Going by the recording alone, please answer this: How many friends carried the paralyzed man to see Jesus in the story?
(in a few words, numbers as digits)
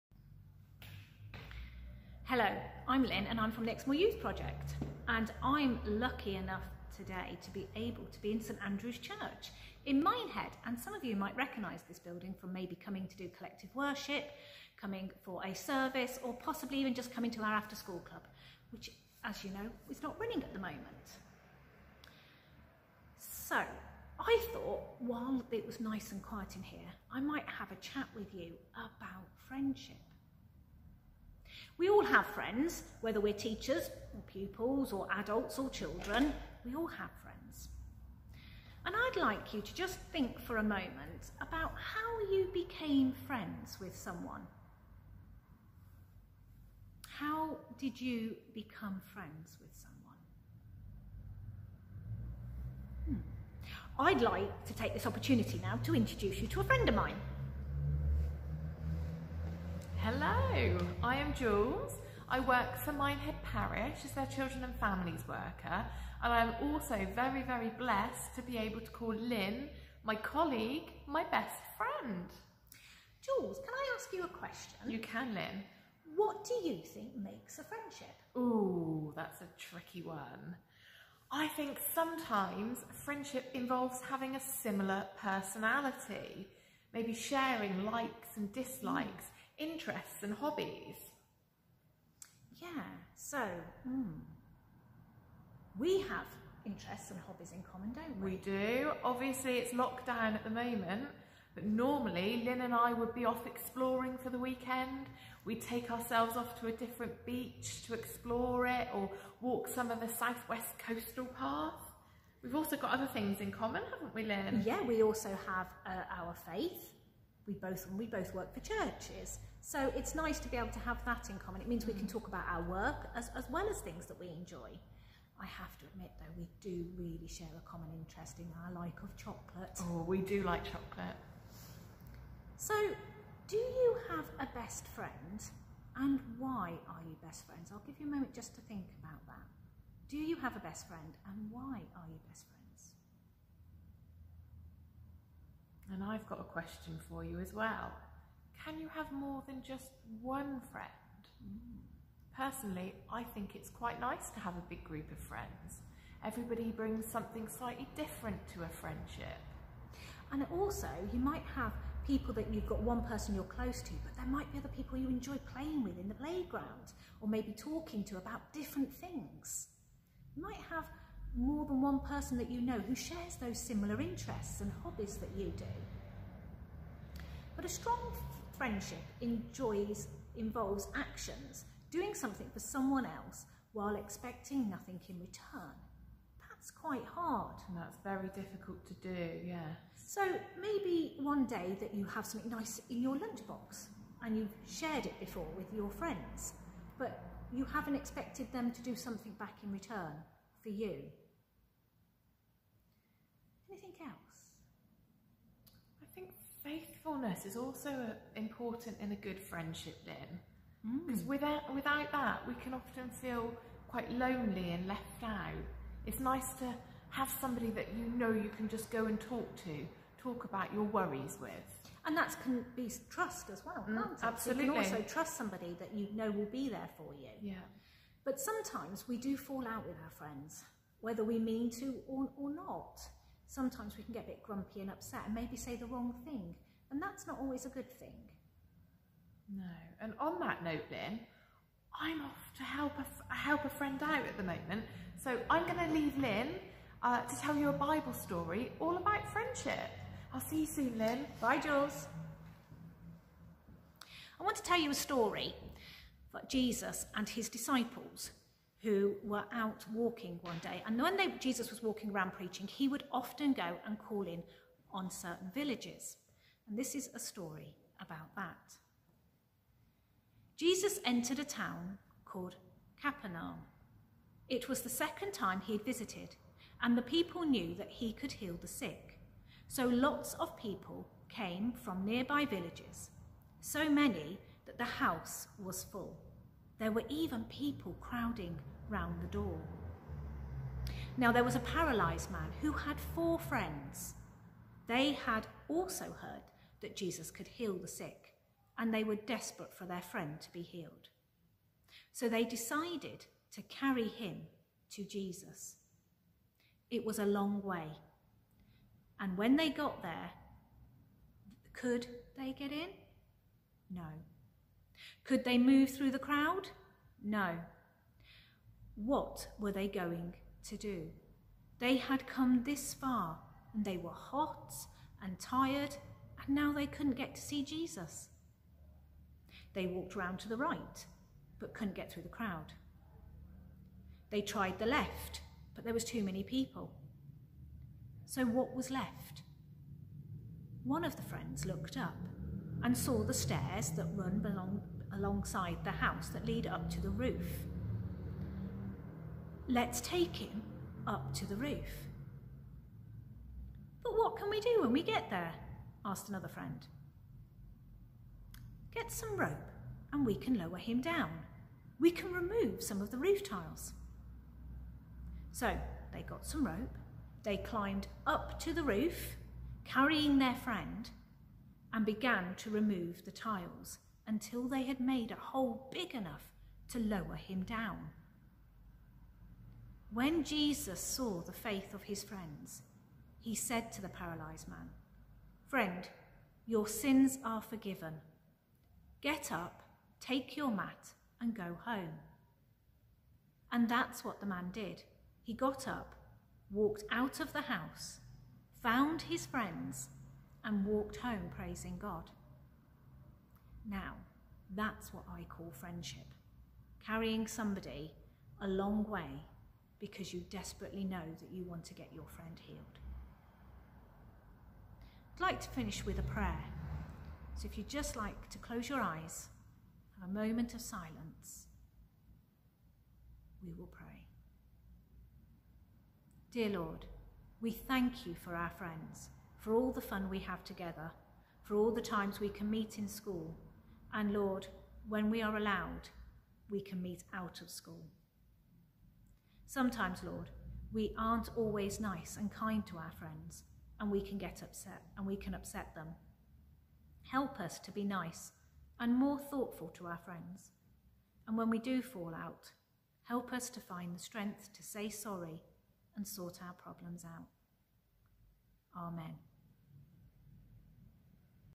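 4.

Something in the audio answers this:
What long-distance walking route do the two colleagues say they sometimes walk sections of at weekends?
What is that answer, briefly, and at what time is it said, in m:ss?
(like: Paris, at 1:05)
Southwest coastal path, at 1:50.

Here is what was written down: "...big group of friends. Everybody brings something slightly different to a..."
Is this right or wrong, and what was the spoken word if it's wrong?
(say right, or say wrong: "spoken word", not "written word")
right.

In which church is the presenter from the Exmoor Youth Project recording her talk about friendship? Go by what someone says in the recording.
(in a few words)
St Andrew's Church.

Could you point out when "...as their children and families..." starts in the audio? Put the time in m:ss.
1:04.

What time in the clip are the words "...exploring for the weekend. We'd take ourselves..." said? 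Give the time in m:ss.
1:43.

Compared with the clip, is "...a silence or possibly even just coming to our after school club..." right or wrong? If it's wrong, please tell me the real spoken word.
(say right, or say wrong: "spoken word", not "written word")
wrong: "service", not "silence".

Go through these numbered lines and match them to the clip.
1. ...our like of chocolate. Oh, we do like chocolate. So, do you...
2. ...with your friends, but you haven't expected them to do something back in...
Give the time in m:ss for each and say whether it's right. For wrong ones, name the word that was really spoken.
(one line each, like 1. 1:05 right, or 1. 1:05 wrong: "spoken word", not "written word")
1. 2:08 right
2. 3:15 right.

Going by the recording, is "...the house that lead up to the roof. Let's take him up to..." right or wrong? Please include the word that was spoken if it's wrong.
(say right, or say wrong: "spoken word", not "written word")
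right.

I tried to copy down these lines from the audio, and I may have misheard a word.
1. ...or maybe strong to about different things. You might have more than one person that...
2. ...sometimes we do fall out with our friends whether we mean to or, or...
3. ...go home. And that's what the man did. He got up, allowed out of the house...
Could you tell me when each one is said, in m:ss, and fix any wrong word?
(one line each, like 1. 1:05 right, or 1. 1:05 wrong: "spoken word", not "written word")
1. 2:47 wrong: "talking", not "strong"
2. 3:48 right
3. 6:31 wrong: "walked", not "allowed".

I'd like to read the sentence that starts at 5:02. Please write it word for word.
So they decided to carry him to Jesus.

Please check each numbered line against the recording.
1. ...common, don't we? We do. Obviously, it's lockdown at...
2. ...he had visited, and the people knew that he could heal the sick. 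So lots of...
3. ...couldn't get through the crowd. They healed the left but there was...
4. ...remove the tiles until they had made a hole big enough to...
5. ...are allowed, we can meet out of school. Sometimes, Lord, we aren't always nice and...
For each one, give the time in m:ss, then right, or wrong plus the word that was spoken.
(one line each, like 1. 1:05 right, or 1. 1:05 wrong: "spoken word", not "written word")
1. 1:37 right
2. 4:35 right
3. 5:31 wrong: "tried", not "healed"
4. 6:12 right
5. 7:15 right.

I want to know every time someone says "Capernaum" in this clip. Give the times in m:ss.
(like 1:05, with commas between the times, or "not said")
4:33.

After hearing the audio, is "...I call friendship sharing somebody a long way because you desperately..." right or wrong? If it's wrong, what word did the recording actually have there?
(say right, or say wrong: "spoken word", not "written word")
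wrong: "carrying", not "sharing".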